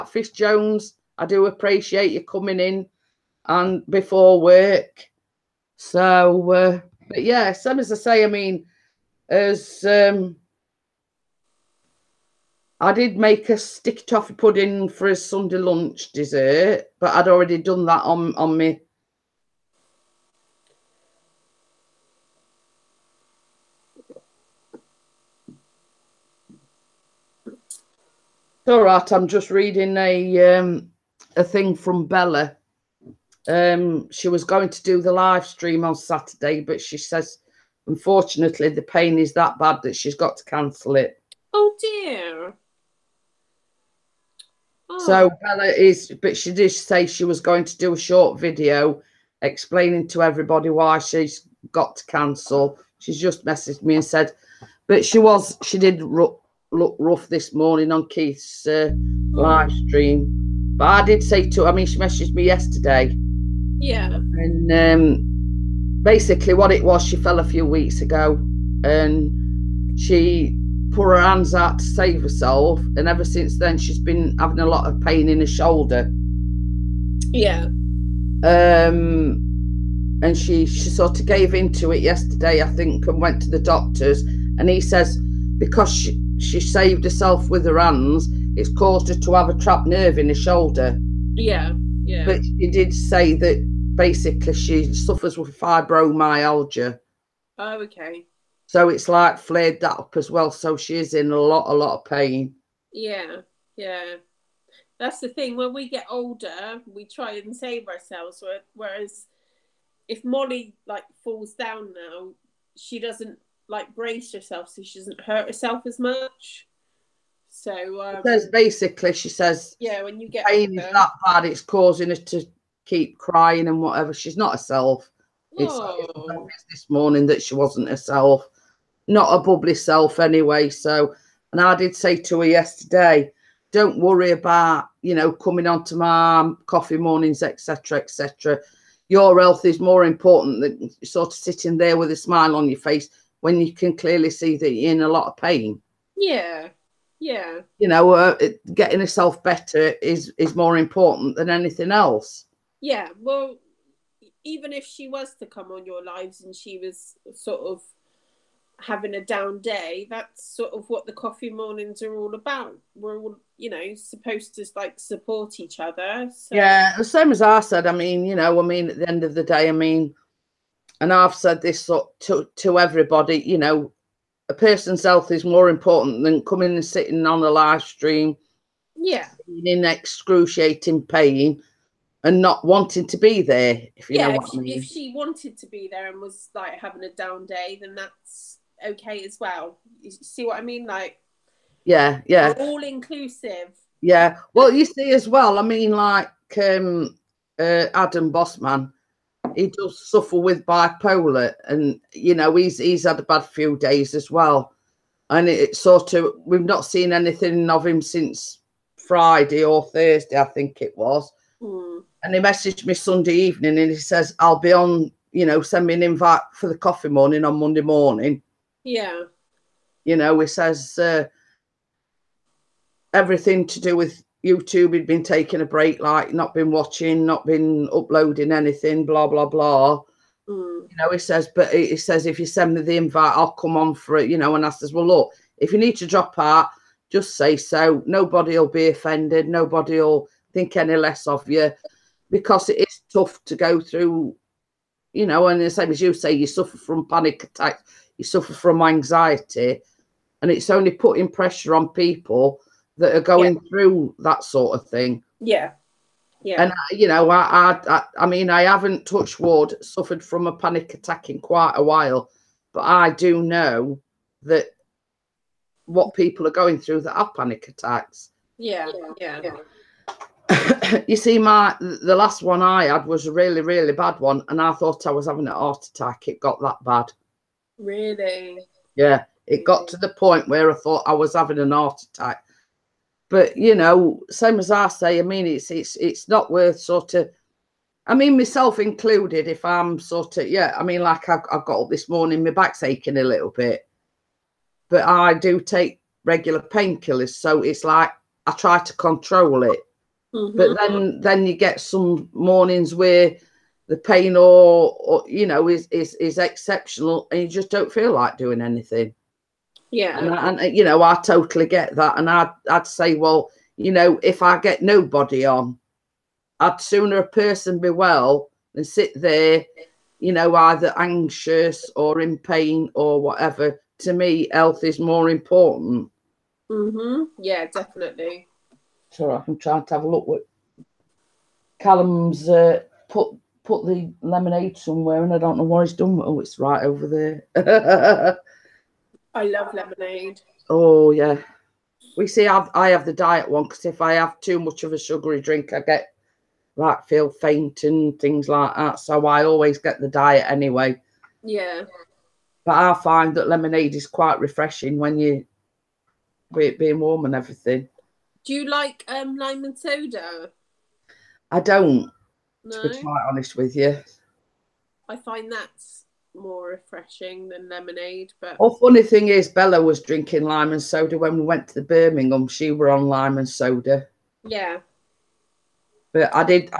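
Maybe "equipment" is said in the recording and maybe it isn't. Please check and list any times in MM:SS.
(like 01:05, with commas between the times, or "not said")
not said.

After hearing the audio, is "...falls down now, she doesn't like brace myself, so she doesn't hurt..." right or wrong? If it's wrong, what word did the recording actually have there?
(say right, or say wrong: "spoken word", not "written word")
wrong: "herself", not "myself".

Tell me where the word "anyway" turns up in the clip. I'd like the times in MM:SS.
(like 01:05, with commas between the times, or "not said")
02:10, 05:50.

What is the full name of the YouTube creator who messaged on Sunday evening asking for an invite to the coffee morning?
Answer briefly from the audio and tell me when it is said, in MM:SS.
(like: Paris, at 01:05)
Adam Bossman, at 03:17.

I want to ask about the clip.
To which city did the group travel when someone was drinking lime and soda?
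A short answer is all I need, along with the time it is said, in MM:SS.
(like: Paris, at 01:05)
Birmingham, at 06:11.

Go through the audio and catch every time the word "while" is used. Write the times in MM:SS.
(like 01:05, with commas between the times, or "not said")
04:21.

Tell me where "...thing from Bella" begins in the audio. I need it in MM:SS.
00:31.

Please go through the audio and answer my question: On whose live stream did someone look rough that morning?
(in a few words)
Keith.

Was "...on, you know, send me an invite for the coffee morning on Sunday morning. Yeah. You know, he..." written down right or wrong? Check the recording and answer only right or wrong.
wrong.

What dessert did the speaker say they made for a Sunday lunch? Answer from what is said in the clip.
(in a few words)
Sticky toffee pudding.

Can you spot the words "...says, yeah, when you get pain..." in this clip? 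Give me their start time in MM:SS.
01:59.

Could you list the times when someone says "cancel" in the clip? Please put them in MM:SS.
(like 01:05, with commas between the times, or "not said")
00:40, 00:52.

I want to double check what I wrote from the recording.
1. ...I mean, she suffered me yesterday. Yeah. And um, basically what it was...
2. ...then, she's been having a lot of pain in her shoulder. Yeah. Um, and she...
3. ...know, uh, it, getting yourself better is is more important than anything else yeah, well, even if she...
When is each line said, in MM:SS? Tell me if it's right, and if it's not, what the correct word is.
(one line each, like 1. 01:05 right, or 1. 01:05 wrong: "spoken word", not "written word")
1. 01:01 wrong: "messaged", not "suffered"
2. 01:13 right
3. 02:27 right.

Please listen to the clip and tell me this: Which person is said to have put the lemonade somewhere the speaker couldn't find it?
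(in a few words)
Callum.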